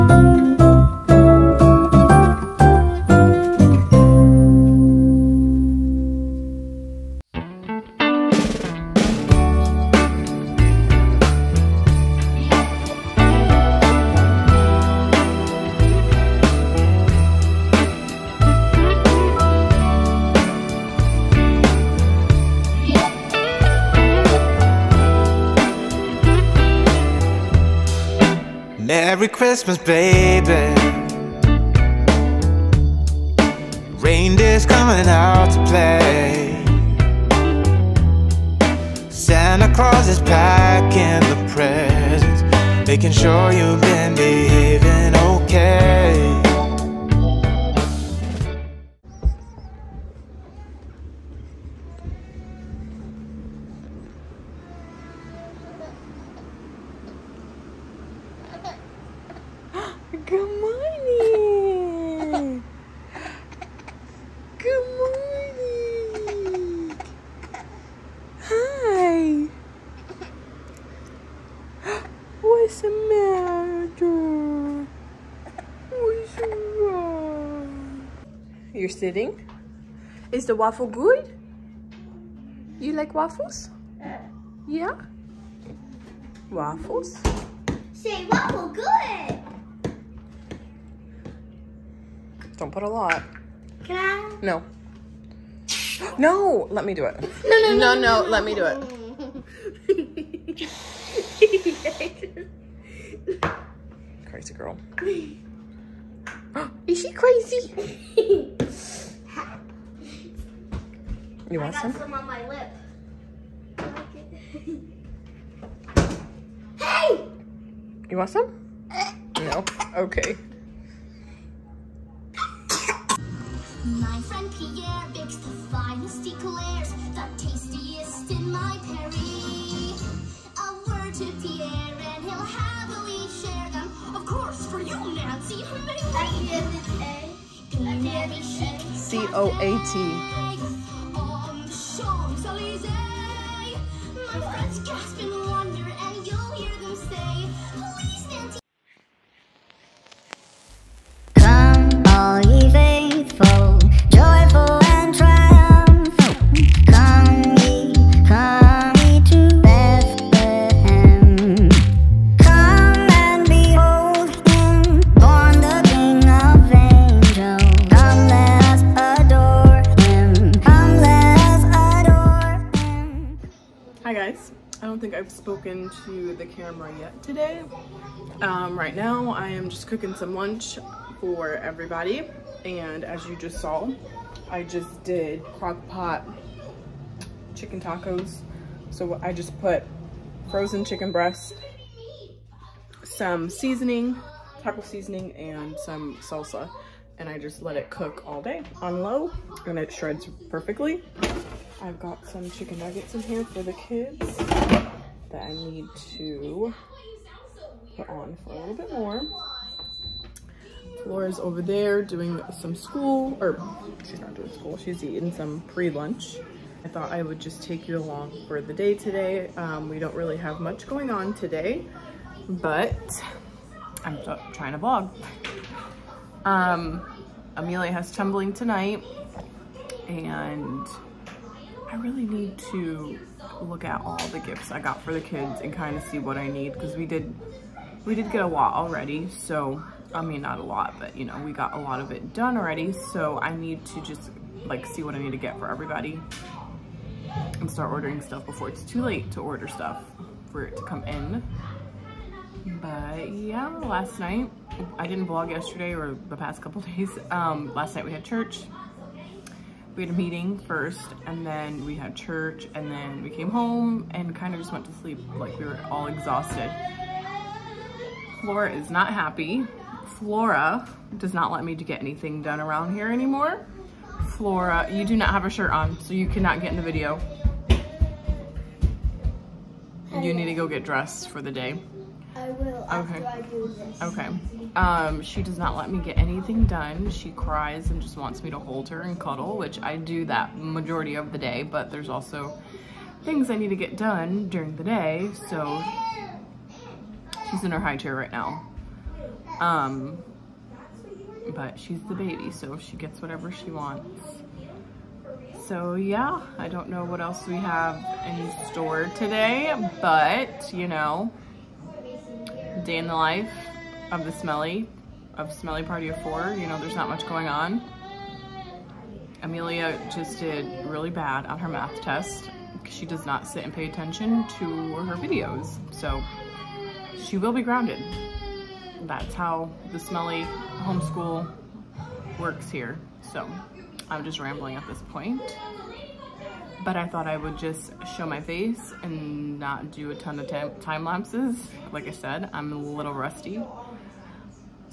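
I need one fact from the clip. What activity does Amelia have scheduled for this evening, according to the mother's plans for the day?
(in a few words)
Tumbling.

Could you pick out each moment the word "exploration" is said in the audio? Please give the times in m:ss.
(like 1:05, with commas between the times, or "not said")
not said.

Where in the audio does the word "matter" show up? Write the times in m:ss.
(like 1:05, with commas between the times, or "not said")
1:12.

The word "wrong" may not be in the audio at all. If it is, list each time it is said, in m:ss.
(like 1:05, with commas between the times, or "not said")
1:16.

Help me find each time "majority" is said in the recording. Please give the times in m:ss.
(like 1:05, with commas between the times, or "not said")
4:50.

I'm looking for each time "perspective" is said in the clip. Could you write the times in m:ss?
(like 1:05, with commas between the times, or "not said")
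not said.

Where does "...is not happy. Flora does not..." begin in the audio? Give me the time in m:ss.
4:28.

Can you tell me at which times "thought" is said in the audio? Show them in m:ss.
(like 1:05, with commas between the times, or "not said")
3:36, 5:37.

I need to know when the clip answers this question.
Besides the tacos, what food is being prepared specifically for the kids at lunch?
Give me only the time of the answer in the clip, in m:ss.
3:22.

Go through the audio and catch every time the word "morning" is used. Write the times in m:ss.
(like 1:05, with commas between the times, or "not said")
1:00, 1:06.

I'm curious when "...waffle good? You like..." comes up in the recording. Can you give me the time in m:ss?
1:20.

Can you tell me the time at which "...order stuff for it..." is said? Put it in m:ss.
4:09.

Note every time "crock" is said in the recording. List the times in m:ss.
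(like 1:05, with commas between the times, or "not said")
3:05.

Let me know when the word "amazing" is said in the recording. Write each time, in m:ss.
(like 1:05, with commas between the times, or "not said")
not said.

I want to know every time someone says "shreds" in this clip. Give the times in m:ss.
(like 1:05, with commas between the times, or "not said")
3:19.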